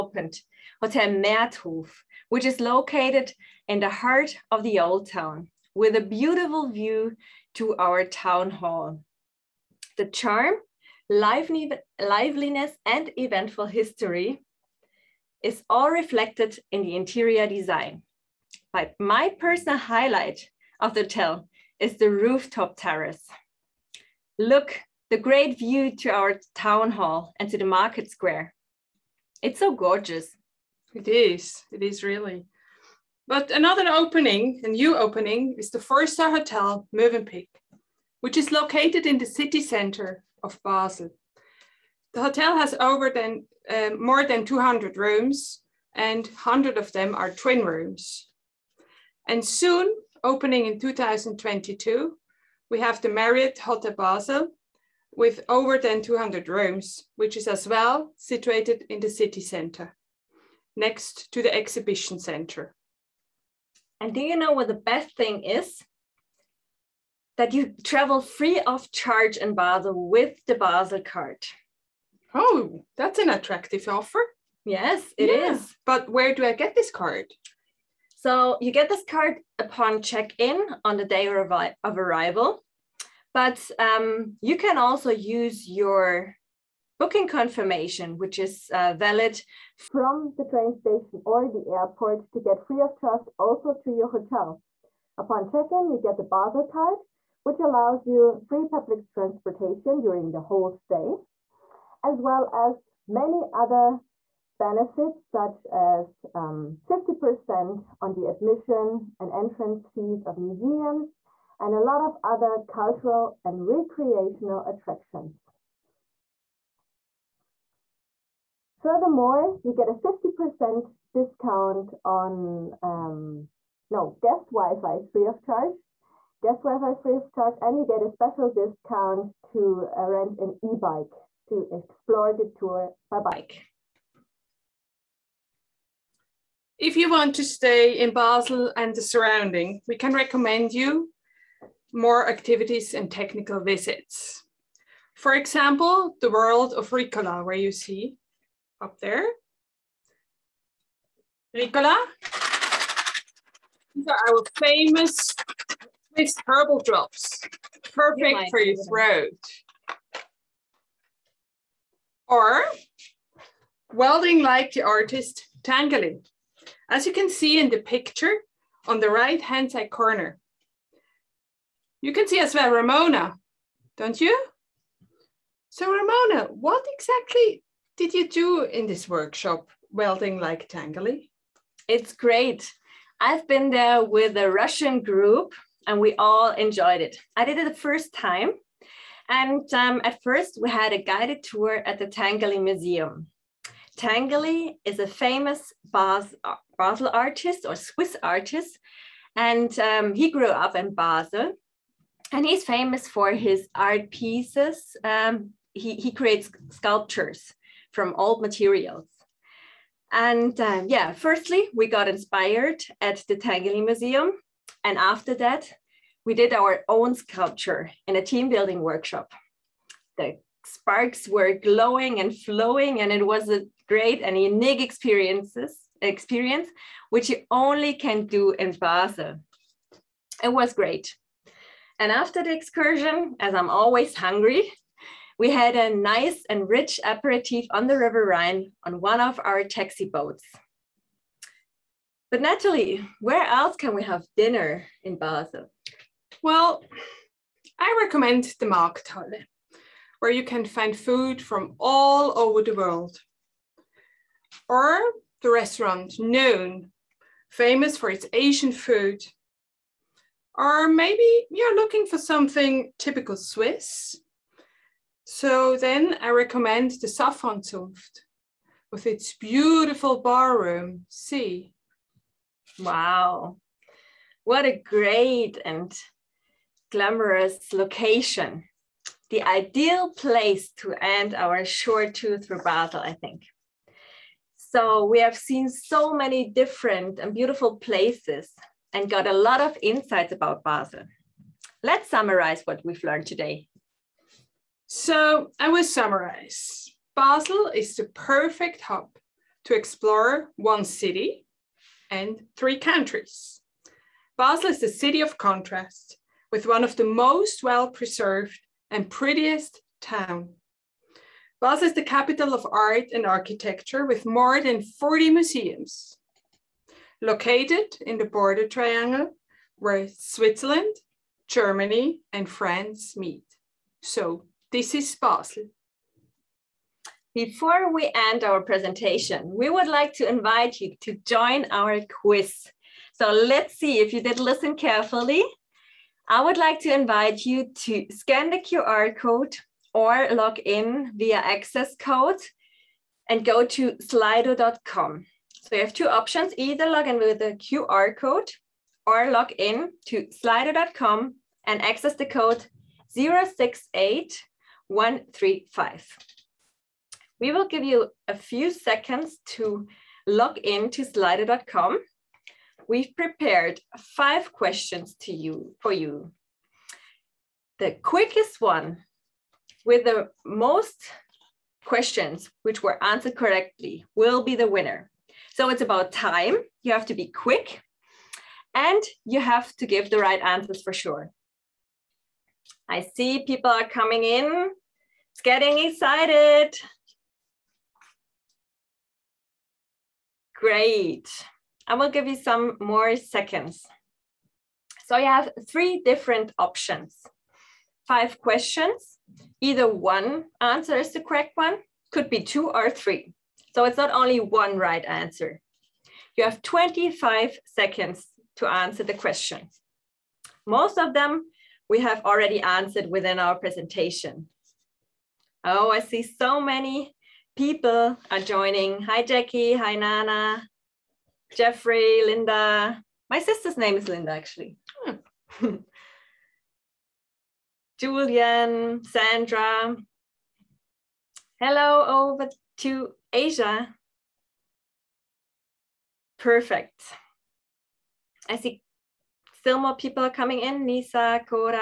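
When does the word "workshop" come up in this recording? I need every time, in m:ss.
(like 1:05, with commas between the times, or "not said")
2:59, 3:38.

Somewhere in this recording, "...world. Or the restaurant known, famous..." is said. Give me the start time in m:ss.
4:12.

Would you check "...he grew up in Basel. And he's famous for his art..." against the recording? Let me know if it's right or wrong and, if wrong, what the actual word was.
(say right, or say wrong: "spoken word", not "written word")
right.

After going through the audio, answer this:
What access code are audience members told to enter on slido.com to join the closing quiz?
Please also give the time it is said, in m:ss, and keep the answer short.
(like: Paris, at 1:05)
068135, at 5:53.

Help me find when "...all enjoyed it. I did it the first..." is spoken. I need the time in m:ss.
3:06.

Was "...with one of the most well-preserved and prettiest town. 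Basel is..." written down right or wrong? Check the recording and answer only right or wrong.
right.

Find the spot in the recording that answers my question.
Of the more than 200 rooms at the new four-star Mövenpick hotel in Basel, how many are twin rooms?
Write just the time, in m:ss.
0:46.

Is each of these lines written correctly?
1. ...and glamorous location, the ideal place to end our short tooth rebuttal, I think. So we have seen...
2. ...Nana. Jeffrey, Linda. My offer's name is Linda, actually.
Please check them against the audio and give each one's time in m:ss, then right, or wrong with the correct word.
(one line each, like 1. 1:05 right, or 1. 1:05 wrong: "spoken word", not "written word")
1. 4:35 right
2. 6:59 wrong: "sister", not "offer".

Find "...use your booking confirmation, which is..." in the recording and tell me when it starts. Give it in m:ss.
1:25.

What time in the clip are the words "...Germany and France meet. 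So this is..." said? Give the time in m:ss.
5:21.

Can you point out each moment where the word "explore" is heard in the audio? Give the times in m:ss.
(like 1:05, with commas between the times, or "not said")
2:11, 4:59.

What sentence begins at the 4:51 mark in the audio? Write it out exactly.
Let's summarize what we've learned today.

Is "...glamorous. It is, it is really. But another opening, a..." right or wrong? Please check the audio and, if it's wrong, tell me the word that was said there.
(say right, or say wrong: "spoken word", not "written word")
wrong: "gorgeous", not "glamorous".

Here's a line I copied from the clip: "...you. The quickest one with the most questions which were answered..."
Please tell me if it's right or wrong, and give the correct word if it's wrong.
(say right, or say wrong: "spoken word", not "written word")
right.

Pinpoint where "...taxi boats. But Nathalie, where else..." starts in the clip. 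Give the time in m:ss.
3:59.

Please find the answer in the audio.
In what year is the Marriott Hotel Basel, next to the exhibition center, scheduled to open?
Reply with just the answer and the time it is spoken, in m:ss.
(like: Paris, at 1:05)
2022, at 0:50.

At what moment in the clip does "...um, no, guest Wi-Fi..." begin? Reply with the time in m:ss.
2:02.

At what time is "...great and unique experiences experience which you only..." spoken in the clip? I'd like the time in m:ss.
3:43.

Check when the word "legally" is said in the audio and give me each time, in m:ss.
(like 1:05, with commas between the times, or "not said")
not said.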